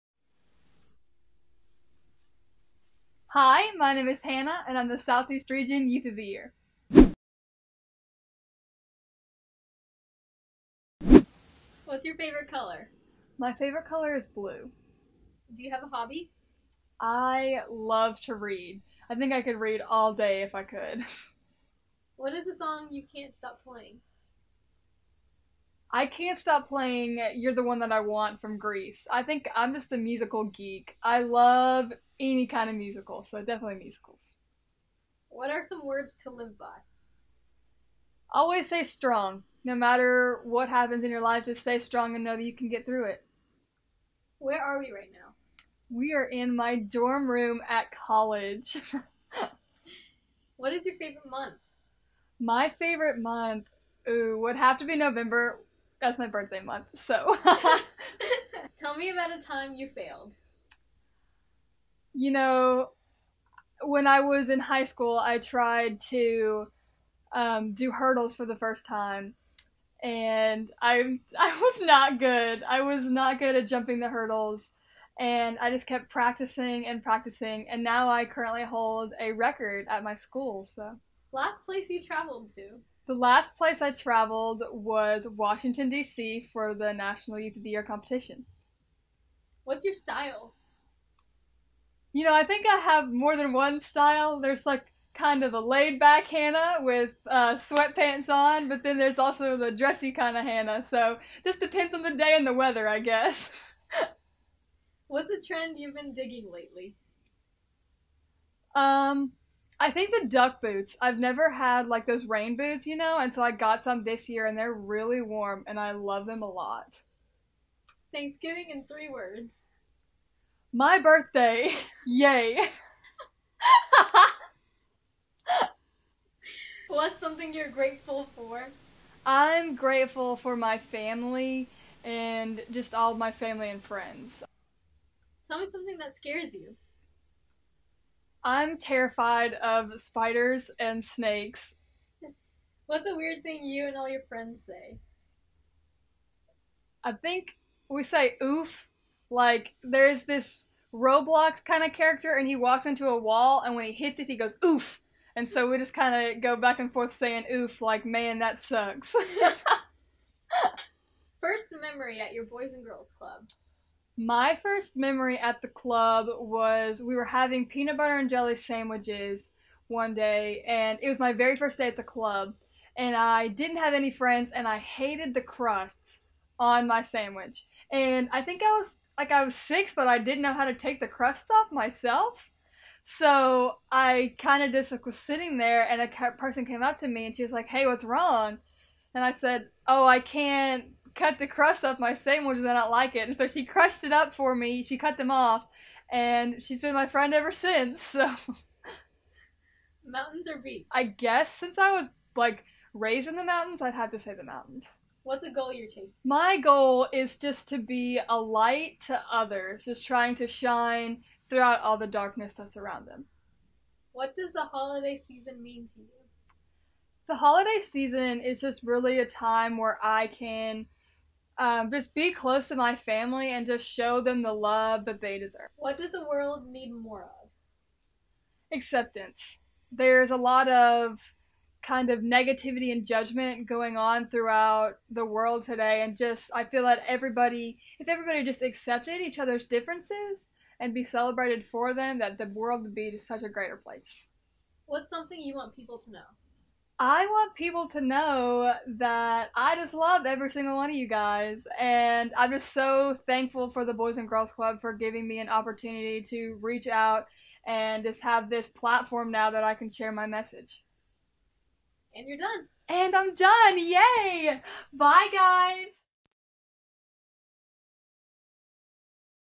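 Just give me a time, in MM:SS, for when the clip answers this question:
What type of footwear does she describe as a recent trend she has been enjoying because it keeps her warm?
01:50.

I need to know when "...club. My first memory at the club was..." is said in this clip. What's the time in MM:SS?
02:43.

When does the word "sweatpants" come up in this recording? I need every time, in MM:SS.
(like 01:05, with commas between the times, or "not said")
01:37.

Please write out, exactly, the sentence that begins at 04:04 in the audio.
What's something you want people to know?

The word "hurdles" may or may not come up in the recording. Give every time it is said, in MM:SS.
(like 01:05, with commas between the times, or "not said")
01:07, 01:14.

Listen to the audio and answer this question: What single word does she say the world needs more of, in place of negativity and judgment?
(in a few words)
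Acceptance.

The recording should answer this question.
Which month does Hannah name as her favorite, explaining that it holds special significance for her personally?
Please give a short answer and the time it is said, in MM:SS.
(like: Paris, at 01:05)
November, at 00:54.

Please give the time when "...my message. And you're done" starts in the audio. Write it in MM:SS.
04:20.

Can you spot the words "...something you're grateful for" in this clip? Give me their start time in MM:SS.
02:07.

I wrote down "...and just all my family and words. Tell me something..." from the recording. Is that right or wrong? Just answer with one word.
wrong.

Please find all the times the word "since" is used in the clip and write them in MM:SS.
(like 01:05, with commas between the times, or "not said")
03:17, 03:21.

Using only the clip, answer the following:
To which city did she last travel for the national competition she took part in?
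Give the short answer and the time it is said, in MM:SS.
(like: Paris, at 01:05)
Washington, D.C., at 01:25.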